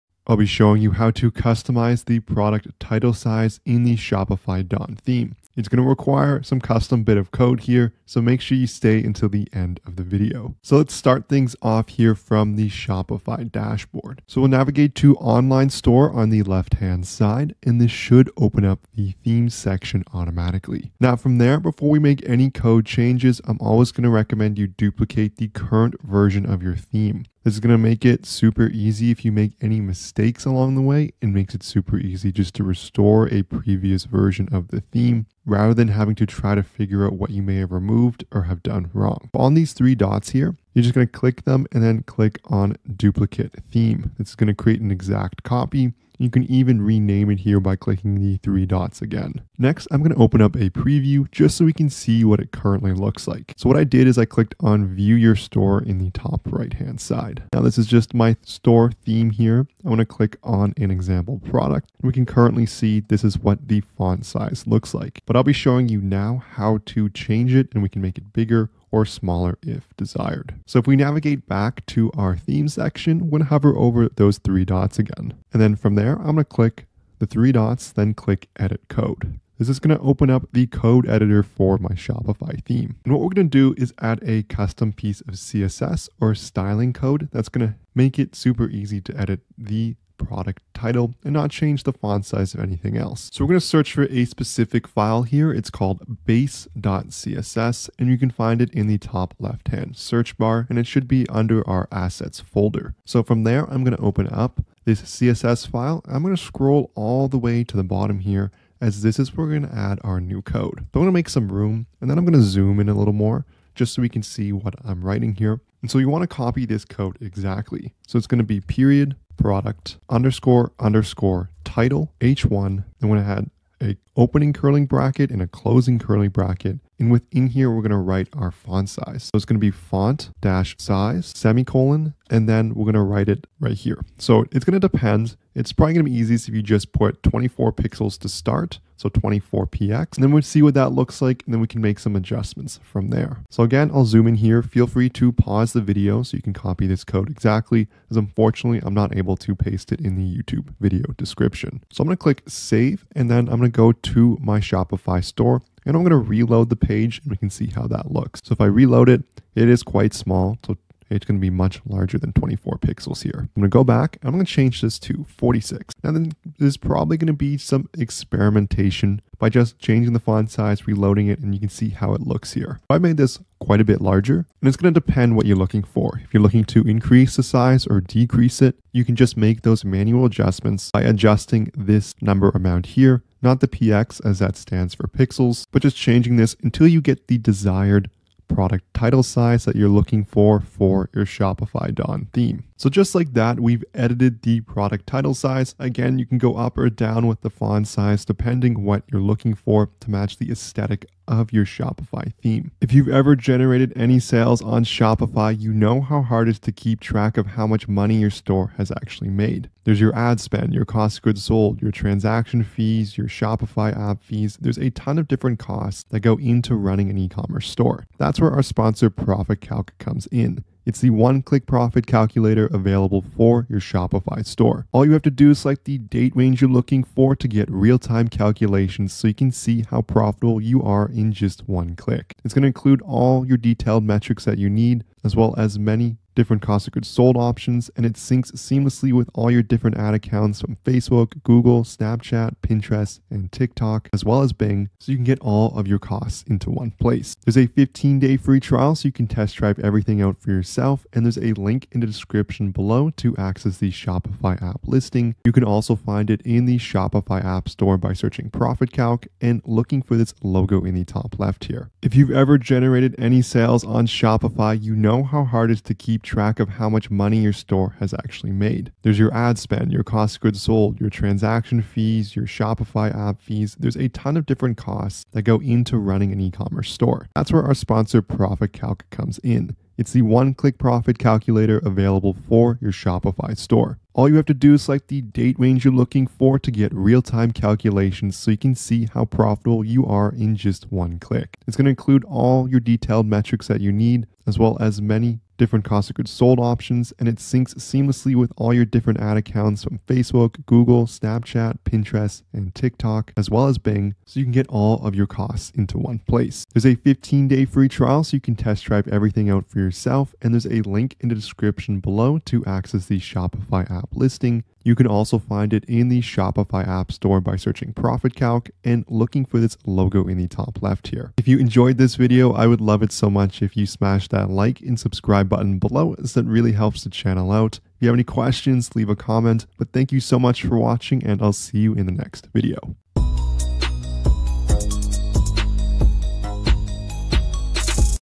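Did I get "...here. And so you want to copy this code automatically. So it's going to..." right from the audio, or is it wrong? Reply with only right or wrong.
wrong.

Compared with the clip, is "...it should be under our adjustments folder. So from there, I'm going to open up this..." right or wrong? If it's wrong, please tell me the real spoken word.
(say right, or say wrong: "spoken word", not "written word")
wrong: "assets", not "adjustments".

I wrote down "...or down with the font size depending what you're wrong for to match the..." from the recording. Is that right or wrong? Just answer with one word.
wrong.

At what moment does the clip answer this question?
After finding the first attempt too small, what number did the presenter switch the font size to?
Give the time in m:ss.
2:45.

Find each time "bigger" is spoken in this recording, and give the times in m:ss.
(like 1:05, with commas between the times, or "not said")
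1:08.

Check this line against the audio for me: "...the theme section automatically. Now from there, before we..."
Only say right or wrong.
right.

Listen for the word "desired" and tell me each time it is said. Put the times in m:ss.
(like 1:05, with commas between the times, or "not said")
1:09, 3:07.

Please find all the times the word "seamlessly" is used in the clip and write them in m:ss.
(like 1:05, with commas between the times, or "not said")
3:58, 4:57.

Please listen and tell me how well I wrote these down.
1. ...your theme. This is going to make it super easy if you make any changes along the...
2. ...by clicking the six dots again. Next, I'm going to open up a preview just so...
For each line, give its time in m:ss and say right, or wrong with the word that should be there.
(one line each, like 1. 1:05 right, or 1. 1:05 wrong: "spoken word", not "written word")
1. 0:26 wrong: "mistakes", not "changes"
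2. 0:47 wrong: "three", not "six".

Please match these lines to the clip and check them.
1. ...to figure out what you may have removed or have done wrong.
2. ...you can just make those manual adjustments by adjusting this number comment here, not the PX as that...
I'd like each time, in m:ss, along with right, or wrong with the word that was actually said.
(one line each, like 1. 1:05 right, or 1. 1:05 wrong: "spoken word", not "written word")
1. 0:36 right
2. 2:58 wrong: "amount", not "comment".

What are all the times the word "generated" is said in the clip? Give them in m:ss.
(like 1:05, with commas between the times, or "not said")
3:23, 4:22.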